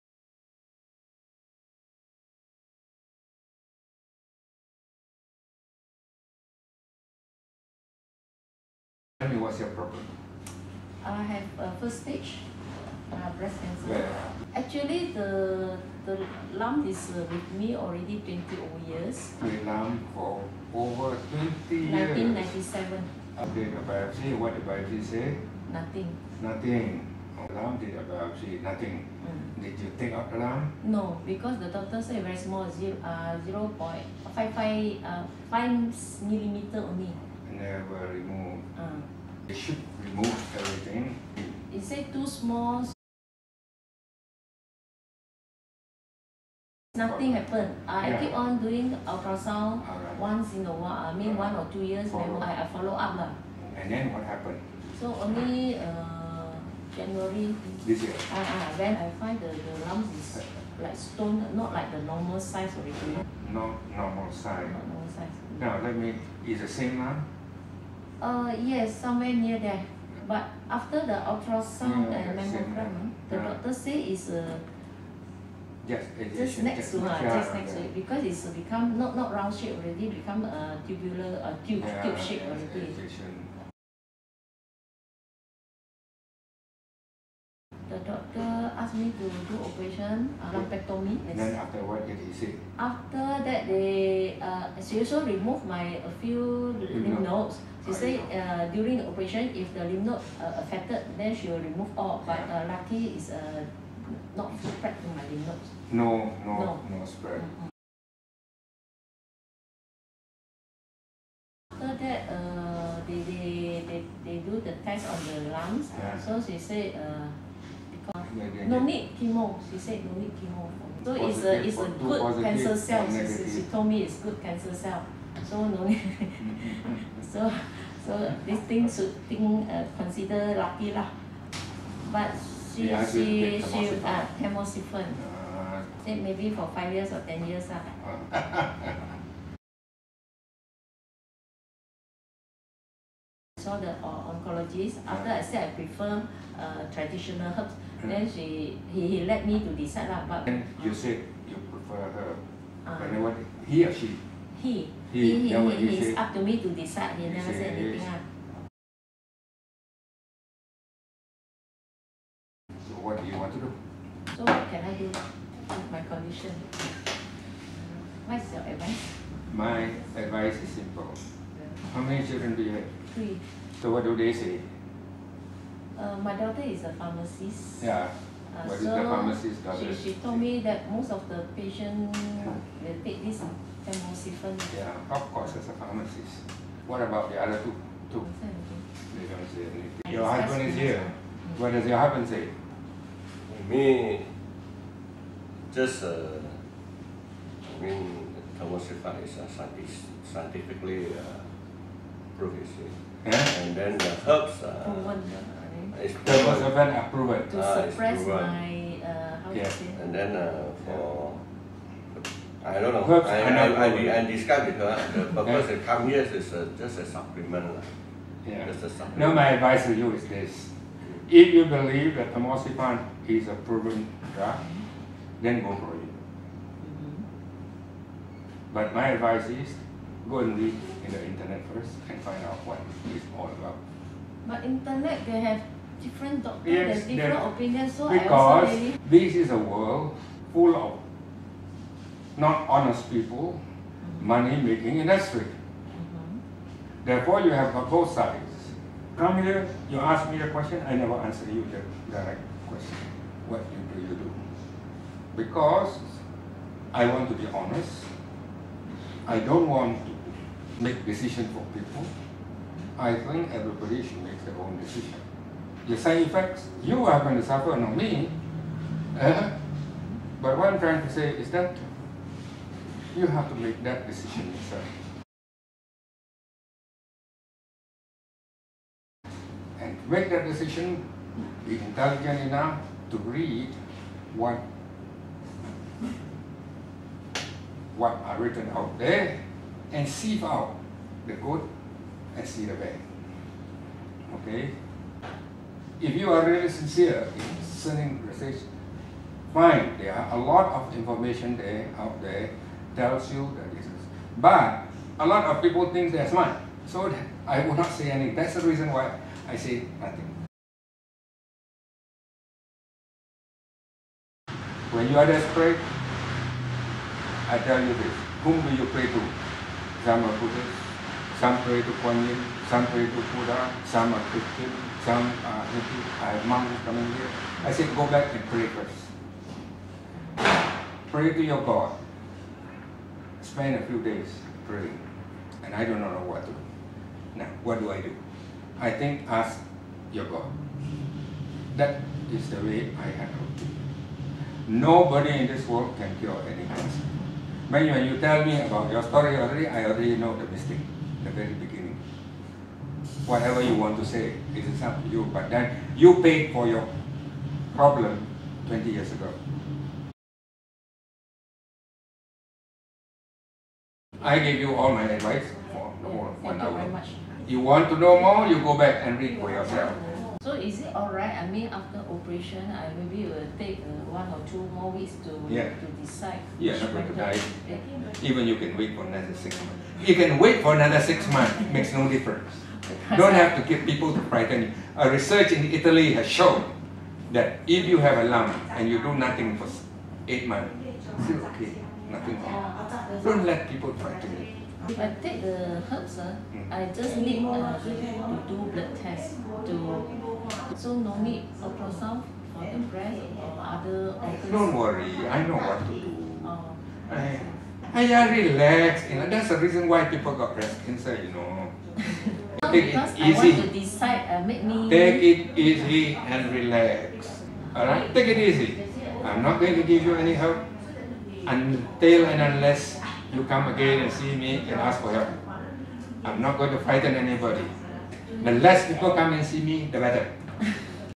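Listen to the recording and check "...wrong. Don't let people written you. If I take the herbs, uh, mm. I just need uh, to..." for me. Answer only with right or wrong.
wrong.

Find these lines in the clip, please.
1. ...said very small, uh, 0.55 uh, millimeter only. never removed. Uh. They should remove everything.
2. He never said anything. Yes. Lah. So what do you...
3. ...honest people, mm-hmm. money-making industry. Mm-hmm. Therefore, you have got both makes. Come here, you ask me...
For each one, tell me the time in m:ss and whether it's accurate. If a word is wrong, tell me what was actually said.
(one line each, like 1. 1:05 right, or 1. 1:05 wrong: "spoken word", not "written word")
1. 0:32 right
2. 2:37 right
3. 4:02 wrong: "sides", not "makes".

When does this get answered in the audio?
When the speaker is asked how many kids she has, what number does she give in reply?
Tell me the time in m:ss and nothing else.
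2:53.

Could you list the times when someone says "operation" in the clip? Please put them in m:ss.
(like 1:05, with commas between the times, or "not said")
1:29, 1:39, 6:12.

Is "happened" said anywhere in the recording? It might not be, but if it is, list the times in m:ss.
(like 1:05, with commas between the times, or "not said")
0:47, 0:54.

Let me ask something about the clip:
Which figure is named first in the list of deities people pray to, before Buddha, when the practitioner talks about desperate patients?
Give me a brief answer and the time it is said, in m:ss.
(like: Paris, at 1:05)
Kuan Yin, at 5:22.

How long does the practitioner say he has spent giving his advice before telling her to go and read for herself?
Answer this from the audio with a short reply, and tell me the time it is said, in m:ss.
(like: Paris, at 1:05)
1 hour, at 6:06.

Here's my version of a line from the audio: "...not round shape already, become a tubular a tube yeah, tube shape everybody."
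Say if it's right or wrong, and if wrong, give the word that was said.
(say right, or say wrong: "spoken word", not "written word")
wrong: "already", not "everybody".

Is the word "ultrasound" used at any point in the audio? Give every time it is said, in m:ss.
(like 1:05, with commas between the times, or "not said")
0:49, 1:11, 6:41.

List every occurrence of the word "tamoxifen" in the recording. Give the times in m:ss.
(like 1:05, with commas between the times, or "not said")
2:14, 3:18, 3:42.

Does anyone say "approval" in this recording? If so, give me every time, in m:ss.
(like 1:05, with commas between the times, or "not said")
3:27.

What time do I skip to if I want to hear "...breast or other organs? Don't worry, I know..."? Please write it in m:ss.
6:42.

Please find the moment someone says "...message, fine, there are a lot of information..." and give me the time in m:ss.
4:58.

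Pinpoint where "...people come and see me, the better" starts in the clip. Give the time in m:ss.
7:08.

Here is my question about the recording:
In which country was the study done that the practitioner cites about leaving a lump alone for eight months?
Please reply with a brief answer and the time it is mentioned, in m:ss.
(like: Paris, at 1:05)
Italy, at 6:25.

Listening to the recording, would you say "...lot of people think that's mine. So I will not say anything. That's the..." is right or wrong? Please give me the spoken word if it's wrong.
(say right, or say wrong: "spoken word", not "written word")
right.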